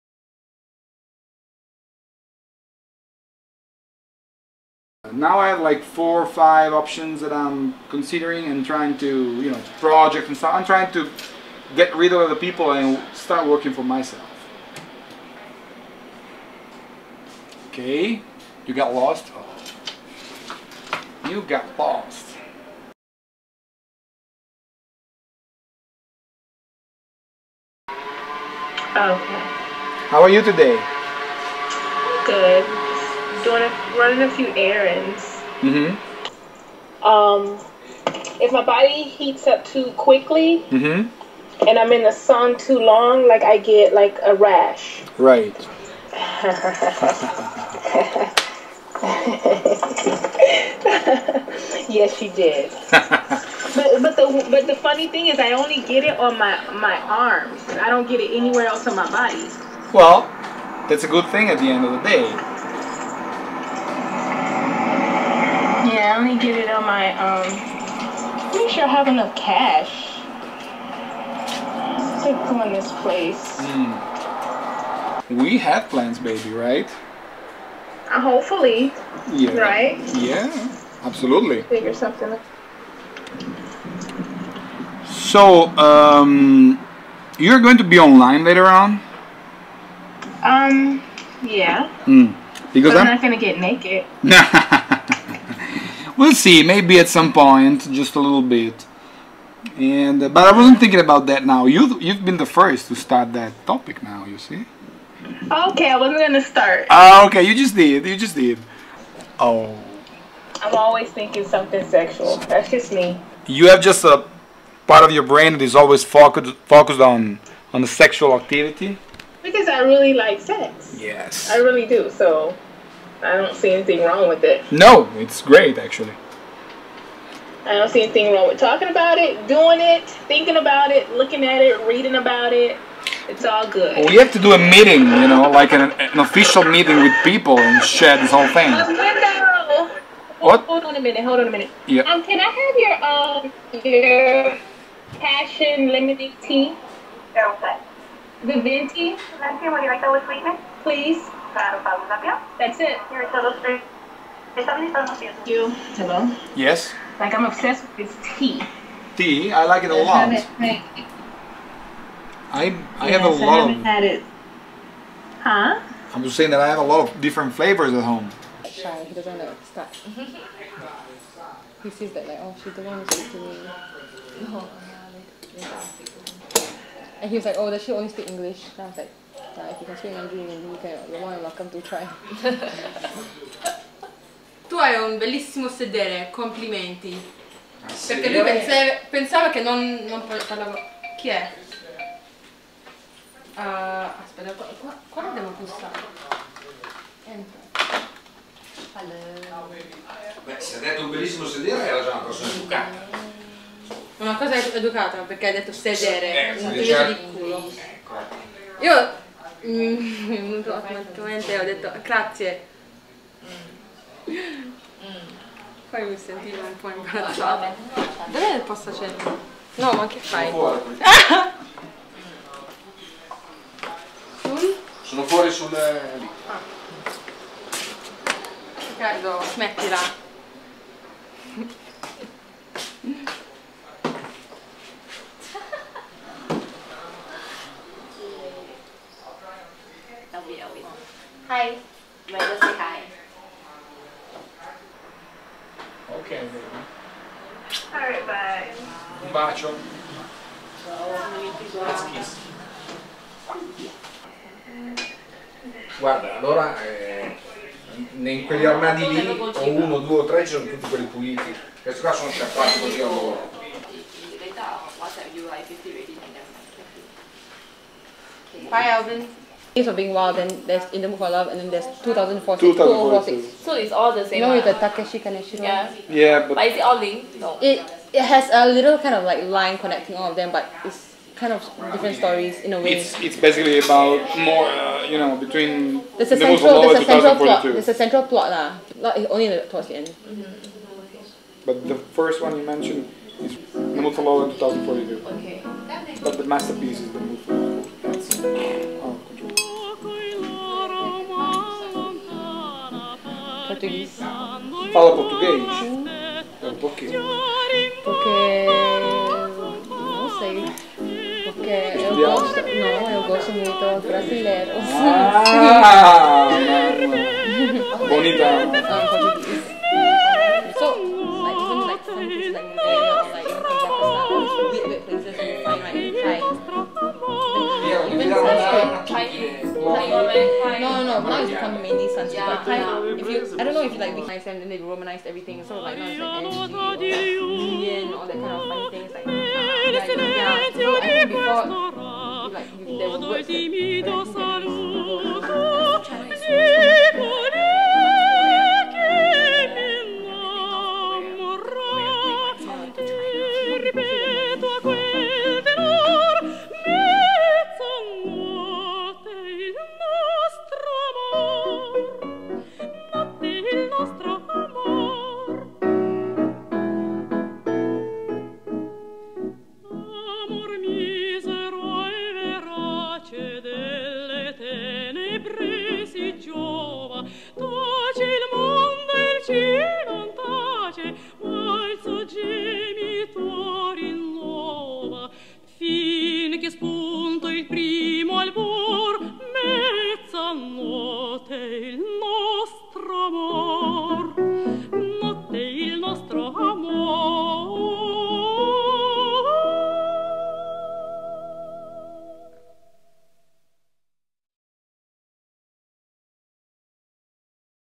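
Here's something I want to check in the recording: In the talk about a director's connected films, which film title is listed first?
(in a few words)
Days of Being Wild.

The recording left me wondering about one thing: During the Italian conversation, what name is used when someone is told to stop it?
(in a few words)
Riccardo.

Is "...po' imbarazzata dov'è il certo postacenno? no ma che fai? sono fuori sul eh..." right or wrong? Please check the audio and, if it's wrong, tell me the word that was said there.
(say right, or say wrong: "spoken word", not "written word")
wrong: "posto", not "certo".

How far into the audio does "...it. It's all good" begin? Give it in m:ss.
2:12.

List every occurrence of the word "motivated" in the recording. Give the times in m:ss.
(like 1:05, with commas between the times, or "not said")
not said.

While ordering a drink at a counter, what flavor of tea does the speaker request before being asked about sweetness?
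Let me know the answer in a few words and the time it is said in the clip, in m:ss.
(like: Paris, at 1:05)
Passion lemonade tea, at 2:25.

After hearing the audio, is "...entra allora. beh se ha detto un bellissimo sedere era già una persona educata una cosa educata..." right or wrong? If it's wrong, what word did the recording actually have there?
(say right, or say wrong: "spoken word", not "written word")
right.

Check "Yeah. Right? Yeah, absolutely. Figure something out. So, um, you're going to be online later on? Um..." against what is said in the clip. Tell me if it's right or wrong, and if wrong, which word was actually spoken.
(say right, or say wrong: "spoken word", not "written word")
right.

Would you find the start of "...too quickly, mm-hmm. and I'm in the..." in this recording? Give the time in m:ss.
0:39.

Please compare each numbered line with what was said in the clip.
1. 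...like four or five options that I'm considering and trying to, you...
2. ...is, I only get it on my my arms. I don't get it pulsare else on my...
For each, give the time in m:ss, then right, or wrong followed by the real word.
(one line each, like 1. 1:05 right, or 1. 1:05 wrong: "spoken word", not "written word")
1. 0:05 right
2. 0:55 wrong: "anywhere", not "pulsare".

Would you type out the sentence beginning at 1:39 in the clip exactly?
And uh, but I wasn't thinking about that now.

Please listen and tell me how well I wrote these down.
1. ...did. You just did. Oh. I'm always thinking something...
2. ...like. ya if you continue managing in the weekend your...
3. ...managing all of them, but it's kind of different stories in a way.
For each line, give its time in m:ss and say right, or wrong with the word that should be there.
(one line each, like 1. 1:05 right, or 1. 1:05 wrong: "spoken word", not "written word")
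1. 1:47 right
2. 2:58 right
3. 4:39 wrong: "connecting", not "managing".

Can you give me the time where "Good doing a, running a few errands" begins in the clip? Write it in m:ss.
0:32.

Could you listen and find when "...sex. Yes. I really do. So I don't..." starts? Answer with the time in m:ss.
2:00.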